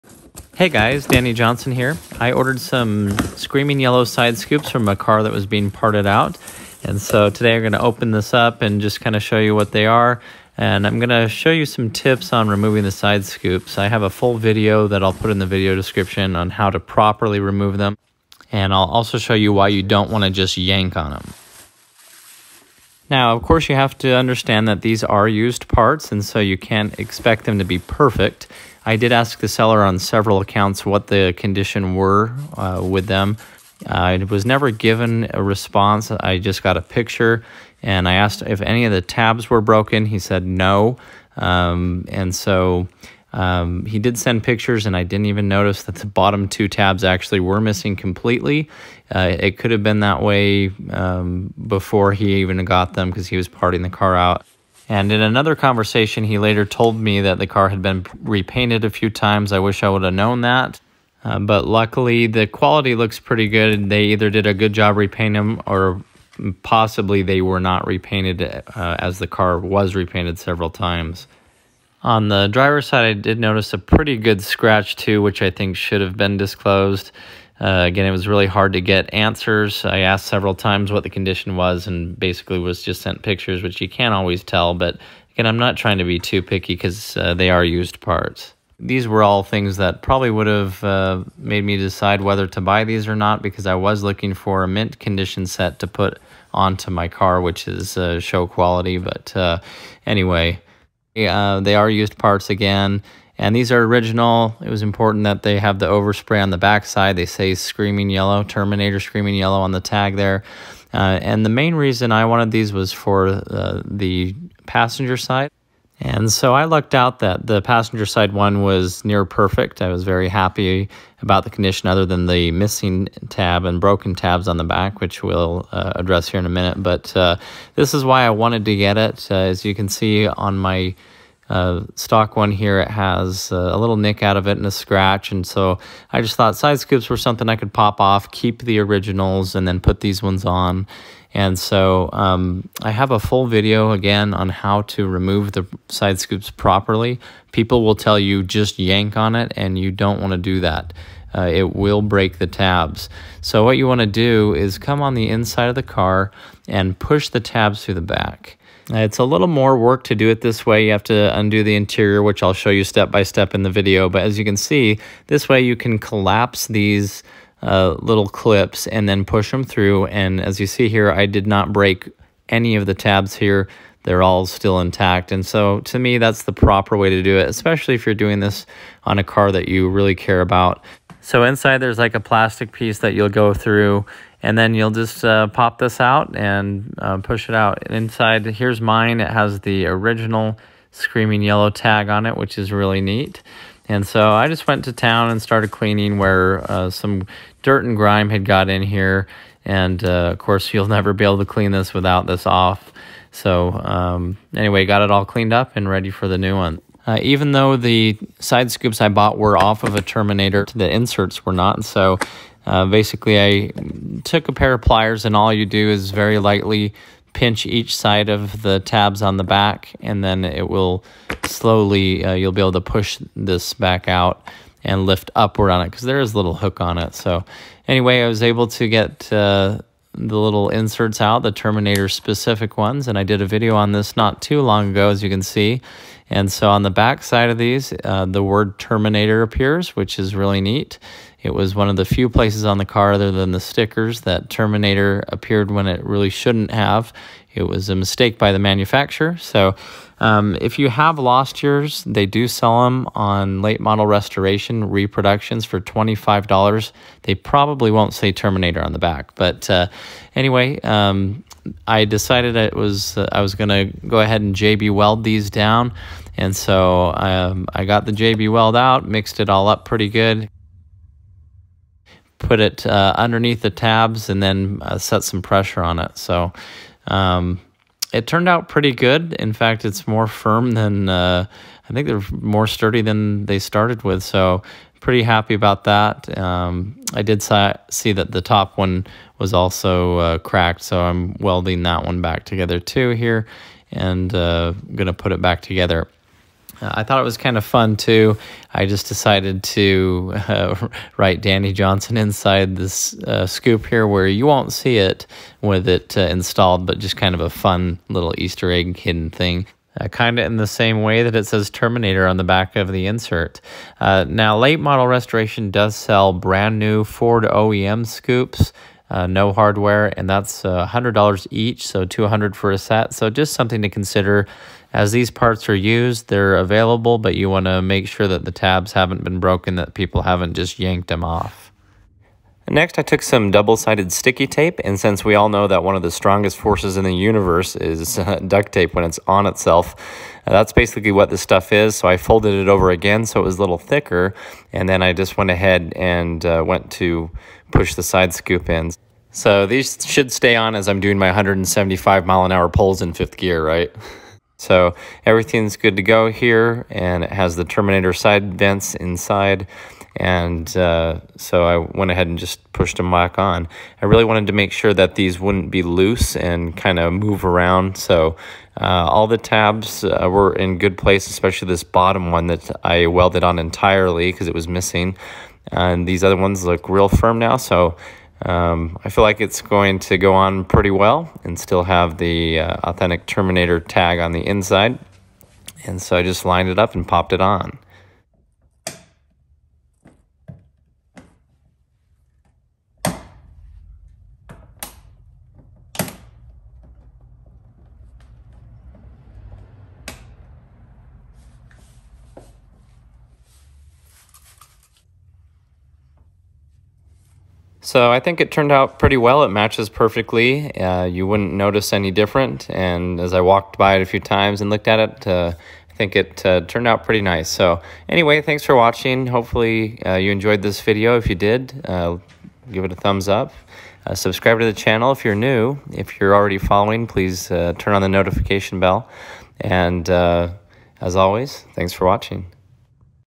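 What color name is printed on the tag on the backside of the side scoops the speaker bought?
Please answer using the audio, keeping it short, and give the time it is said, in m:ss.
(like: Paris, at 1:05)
Terminator Screaming Yellow, at 1:48.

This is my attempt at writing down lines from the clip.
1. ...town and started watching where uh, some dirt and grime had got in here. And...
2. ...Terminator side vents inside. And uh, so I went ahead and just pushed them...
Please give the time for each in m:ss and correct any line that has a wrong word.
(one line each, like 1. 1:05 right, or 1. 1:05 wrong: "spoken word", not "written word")
1. 3:14 wrong: "cleaning", not "watching"
2. 5:57 right.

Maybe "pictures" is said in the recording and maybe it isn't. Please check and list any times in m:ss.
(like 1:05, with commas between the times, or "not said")
0:36, 0:44, 1:23.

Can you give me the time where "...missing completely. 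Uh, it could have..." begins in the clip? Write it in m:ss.
0:47.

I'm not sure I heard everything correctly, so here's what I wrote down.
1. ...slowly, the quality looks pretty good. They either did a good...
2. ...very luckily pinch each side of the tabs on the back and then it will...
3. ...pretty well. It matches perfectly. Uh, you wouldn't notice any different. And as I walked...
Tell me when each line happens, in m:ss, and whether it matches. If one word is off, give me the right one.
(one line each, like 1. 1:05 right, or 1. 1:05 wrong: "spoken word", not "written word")
1. 1:01 wrong: "luckily", not "slowly"
2. 3:36 wrong: "lightly", not "luckily"
3. 6:48 right.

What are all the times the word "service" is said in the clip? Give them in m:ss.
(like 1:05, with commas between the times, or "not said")
not said.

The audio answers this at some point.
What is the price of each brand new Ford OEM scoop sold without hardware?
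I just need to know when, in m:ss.
5:20.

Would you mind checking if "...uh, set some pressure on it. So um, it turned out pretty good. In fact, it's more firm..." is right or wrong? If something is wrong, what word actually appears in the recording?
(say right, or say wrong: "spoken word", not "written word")
right.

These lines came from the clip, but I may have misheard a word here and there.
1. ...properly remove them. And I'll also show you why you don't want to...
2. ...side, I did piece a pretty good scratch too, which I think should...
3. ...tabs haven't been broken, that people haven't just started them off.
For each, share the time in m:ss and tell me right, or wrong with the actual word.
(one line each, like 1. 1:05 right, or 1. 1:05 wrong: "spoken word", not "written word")
1. 0:16 right
2. 1:12 wrong: "notice", not "piece"
3. 5:28 wrong: "yanked", not "started".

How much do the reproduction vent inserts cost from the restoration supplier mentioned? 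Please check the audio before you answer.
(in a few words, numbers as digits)
$25.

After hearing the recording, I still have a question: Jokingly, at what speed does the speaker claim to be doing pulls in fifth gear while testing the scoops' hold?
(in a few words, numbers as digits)
175 mph.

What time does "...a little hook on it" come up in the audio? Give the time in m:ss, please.
3:46.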